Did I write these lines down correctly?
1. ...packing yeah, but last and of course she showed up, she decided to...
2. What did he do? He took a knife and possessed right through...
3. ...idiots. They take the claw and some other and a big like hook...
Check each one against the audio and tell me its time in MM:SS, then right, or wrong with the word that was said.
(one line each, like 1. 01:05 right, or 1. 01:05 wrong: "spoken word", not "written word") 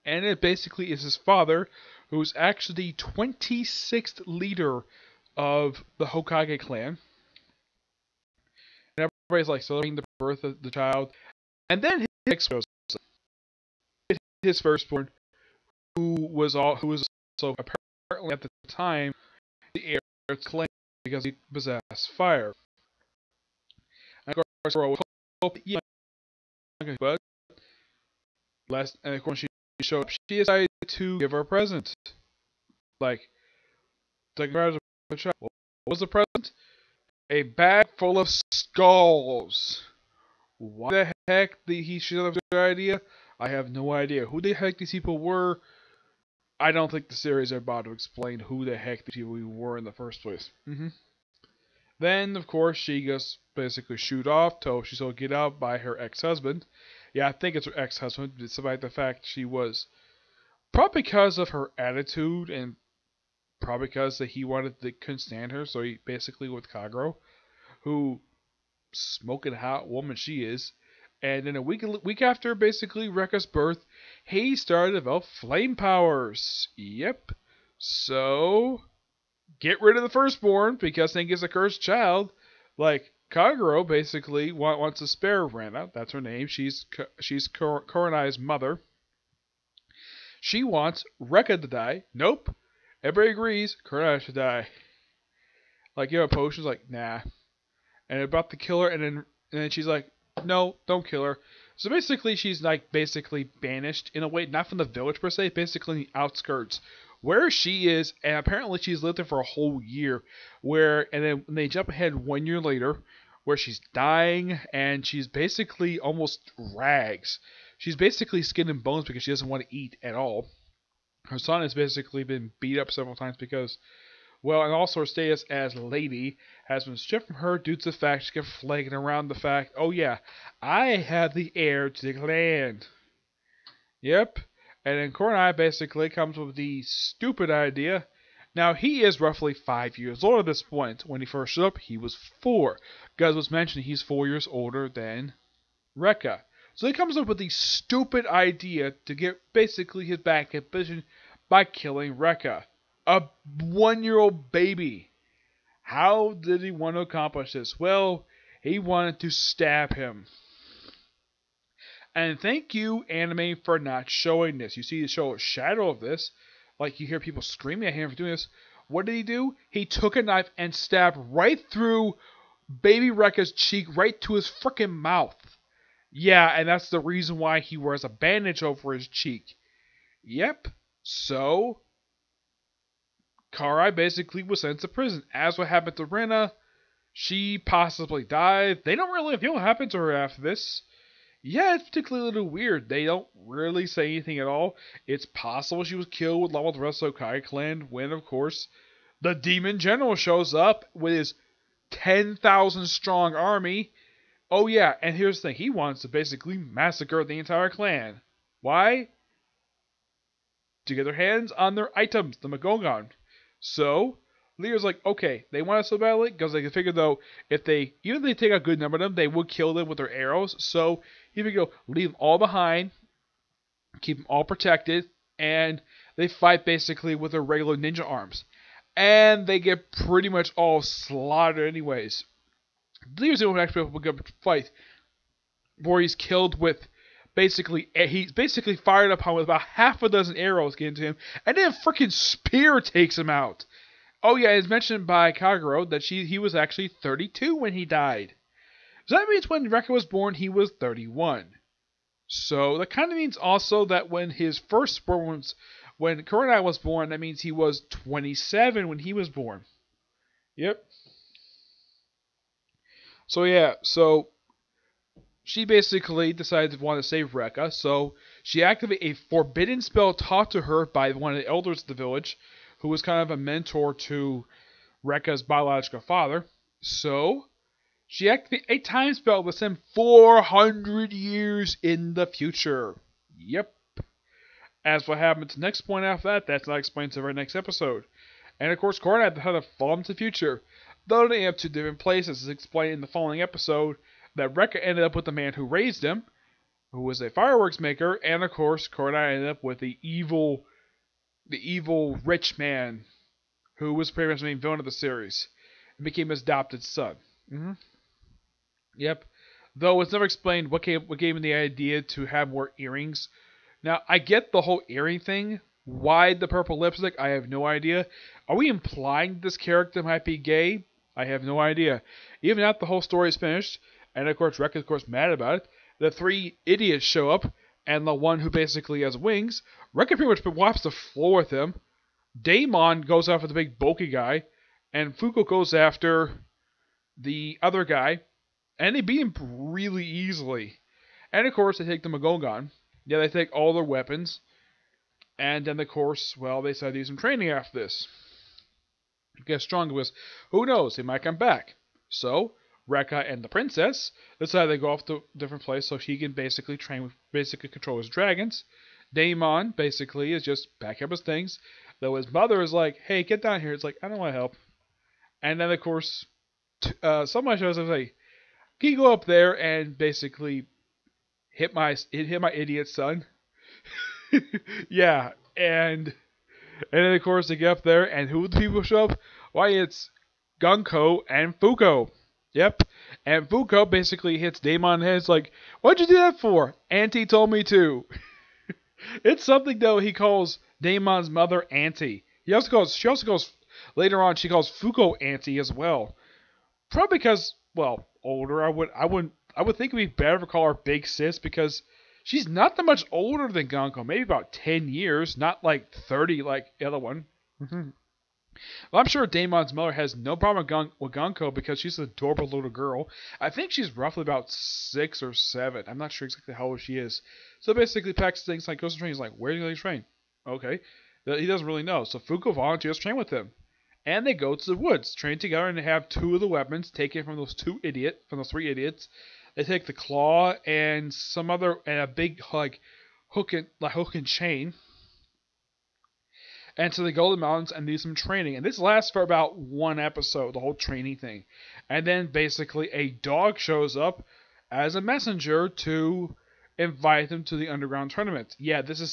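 1. 00:25 wrong: "hoping", not "packing"
2. 02:48 wrong: "stabbed", not "possessed"
3. 07:08 right.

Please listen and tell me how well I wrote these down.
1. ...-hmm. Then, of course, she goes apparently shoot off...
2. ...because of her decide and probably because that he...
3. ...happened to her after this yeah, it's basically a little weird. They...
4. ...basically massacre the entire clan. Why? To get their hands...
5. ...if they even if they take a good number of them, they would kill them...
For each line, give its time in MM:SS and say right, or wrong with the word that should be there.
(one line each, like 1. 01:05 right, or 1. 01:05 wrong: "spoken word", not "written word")
1. 00:50 wrong: "basically", not "apparently"
2. 01:01 wrong: "attitude", not "decide"
3. 03:09 wrong: "particularly", not "basically"
4. 03:26 right
5. 03:37 right.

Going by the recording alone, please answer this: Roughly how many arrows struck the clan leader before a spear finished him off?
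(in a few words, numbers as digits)
half a dozen.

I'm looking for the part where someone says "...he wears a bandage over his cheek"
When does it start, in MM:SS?
02:57.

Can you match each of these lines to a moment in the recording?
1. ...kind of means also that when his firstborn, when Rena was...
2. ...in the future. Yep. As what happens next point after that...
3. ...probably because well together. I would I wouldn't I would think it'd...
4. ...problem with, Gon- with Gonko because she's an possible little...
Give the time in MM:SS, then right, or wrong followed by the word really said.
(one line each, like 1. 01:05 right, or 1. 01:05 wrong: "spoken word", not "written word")
1. 04:12 wrong: "Kurenai", not "Rena"
2. 04:41 right
3. 06:36 wrong: "older", not "together"
4. 06:50 wrong: "adorable", not "possible".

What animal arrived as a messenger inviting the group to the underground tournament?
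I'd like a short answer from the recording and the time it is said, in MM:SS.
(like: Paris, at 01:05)
a dog, at 07:22.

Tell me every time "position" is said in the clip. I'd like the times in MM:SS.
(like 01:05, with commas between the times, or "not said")
02:30.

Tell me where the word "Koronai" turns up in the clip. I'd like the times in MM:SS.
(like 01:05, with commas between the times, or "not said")
01:27, 01:33.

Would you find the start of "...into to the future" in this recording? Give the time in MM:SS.
04:49.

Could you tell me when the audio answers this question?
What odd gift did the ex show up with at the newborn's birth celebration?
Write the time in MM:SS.
00:37.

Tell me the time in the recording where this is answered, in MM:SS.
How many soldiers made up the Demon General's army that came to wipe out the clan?
03:21.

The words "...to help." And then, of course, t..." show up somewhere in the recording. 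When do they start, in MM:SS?
06:04.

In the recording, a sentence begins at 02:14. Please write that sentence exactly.
Yep, and then Kornai basically comes with the stupid idea.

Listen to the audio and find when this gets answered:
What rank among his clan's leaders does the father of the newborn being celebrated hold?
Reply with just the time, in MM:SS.
00:02.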